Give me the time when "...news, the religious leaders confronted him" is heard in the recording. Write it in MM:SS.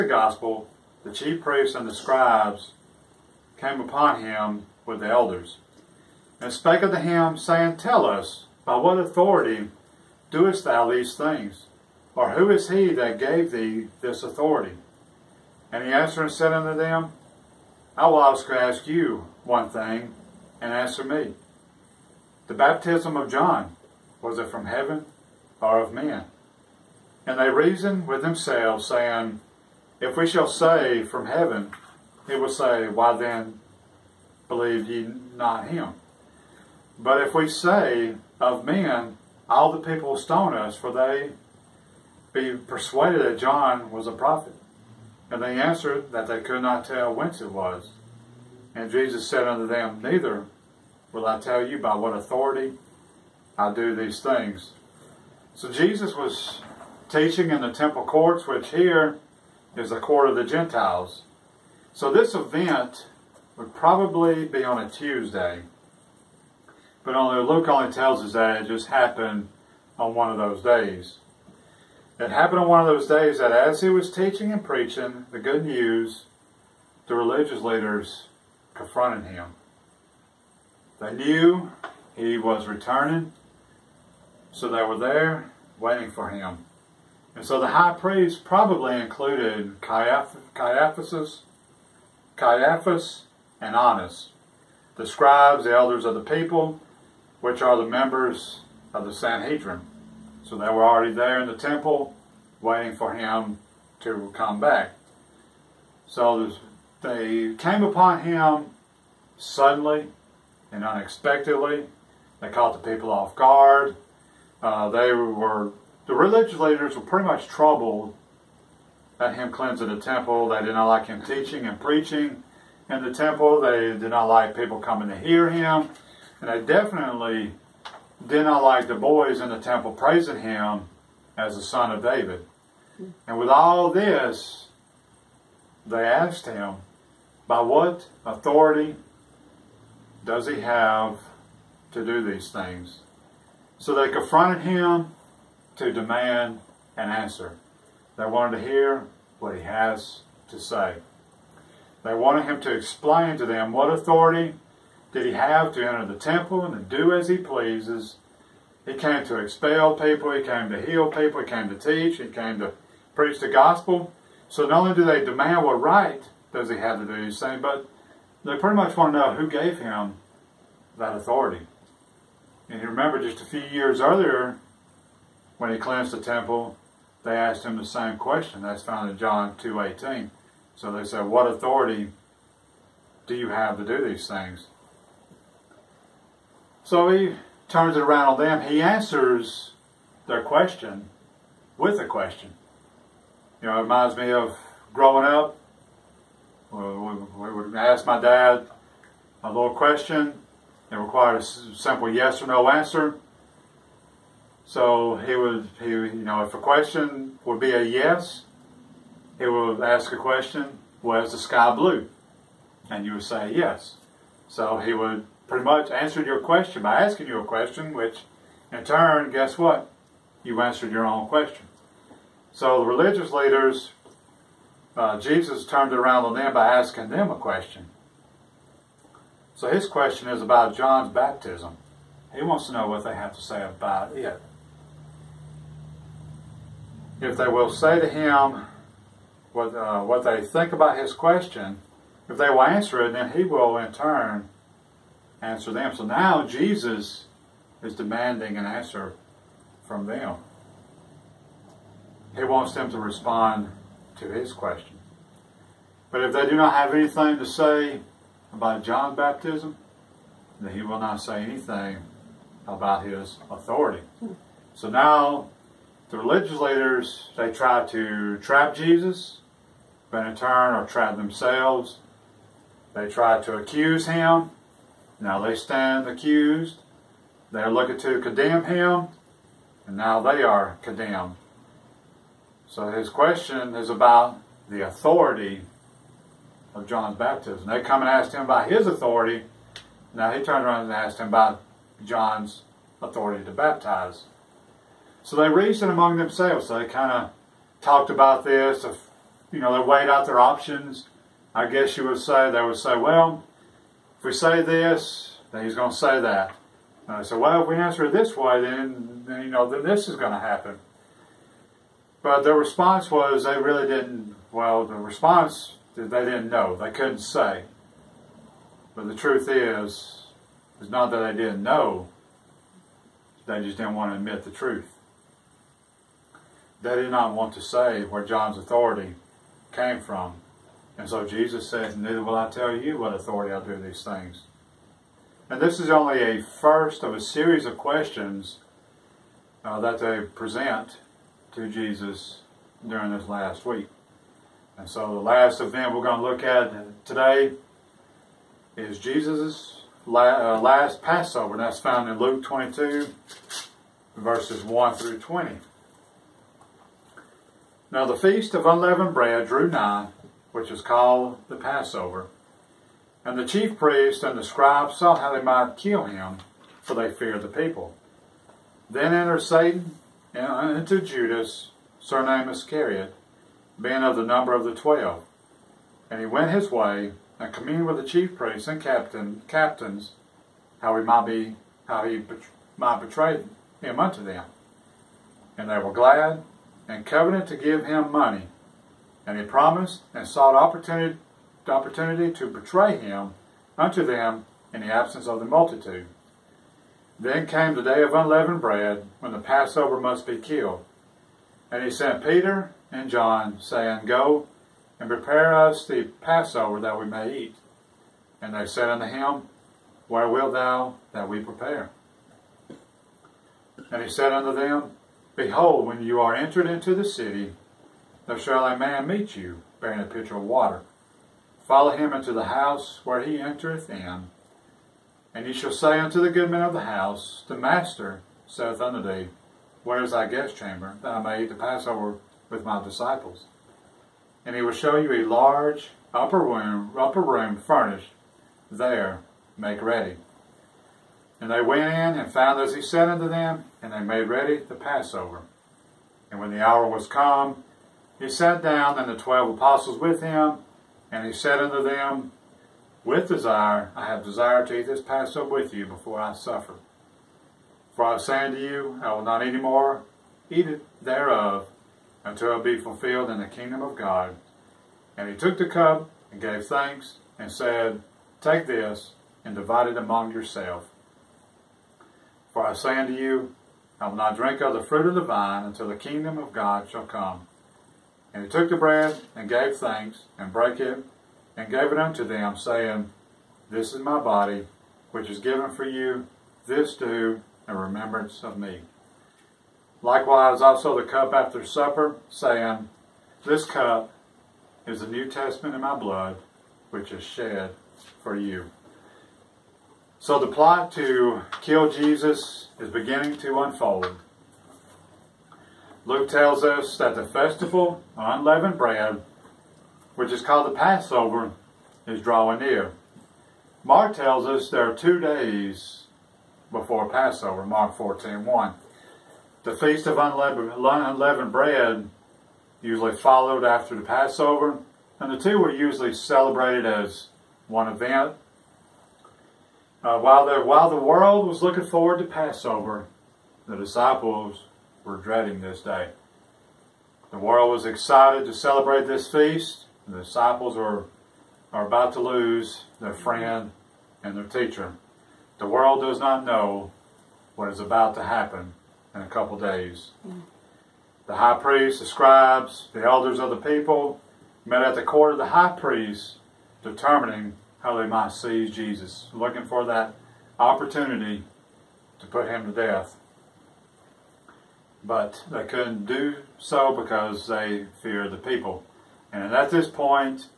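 01:15.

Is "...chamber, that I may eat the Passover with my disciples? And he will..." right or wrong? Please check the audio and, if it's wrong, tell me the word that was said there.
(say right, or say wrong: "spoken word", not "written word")
right.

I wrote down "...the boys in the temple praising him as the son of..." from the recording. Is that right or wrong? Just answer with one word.
right.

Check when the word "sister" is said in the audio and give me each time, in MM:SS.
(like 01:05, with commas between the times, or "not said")
not said.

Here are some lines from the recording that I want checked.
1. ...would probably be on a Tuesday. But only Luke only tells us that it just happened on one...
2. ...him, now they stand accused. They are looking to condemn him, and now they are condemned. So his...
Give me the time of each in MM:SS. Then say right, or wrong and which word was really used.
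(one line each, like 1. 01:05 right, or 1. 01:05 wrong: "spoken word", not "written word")
1. 01:03 right
2. 04:34 right.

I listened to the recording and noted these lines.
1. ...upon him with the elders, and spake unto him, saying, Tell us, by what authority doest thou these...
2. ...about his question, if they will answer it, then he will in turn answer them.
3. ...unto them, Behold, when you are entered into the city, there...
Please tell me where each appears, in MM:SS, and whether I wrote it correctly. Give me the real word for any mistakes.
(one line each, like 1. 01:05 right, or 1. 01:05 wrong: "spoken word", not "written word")
1. 00:03 right
2. 04:00 right
3. 06:54 right.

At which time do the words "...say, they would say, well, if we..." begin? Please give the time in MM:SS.
05:02.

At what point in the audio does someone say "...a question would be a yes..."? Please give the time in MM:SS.
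03:26.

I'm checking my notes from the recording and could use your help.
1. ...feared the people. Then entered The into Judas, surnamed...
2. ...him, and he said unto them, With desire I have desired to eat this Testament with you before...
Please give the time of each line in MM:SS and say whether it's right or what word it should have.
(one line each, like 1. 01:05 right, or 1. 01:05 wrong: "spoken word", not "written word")
1. 06:07 wrong: "Satan", not "The"
2. 07:30 wrong: "Passover", not "Testament".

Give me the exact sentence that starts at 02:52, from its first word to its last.
And you remember just a few years earlier, when he cleansed the temple, they asked him the same question.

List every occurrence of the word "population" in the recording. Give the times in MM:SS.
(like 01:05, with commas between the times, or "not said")
not said.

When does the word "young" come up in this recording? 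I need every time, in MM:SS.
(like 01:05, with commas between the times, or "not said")
not said.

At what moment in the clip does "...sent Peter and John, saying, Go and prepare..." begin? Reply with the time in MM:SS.
06:41.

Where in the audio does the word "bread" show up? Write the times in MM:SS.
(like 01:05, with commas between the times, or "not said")
05:59, 06:38, 07:58, 08:28, 08:41.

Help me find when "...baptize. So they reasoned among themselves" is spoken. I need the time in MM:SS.
04:53.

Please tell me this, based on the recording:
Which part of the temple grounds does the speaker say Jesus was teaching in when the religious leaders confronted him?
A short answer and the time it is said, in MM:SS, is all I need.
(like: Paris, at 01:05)
Court of the Gentiles, at 00:59.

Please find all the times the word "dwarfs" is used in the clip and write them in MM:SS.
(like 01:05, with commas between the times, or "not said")
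not said.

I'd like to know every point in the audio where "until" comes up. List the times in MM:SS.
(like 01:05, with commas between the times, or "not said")
07:42, 07:55.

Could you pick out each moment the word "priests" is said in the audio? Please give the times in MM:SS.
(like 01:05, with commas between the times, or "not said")
00:01, 01:27, 06:03, 06:18, 09:11, 09:15.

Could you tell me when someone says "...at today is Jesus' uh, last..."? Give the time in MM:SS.
05:46.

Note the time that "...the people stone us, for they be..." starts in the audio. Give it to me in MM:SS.
00:39.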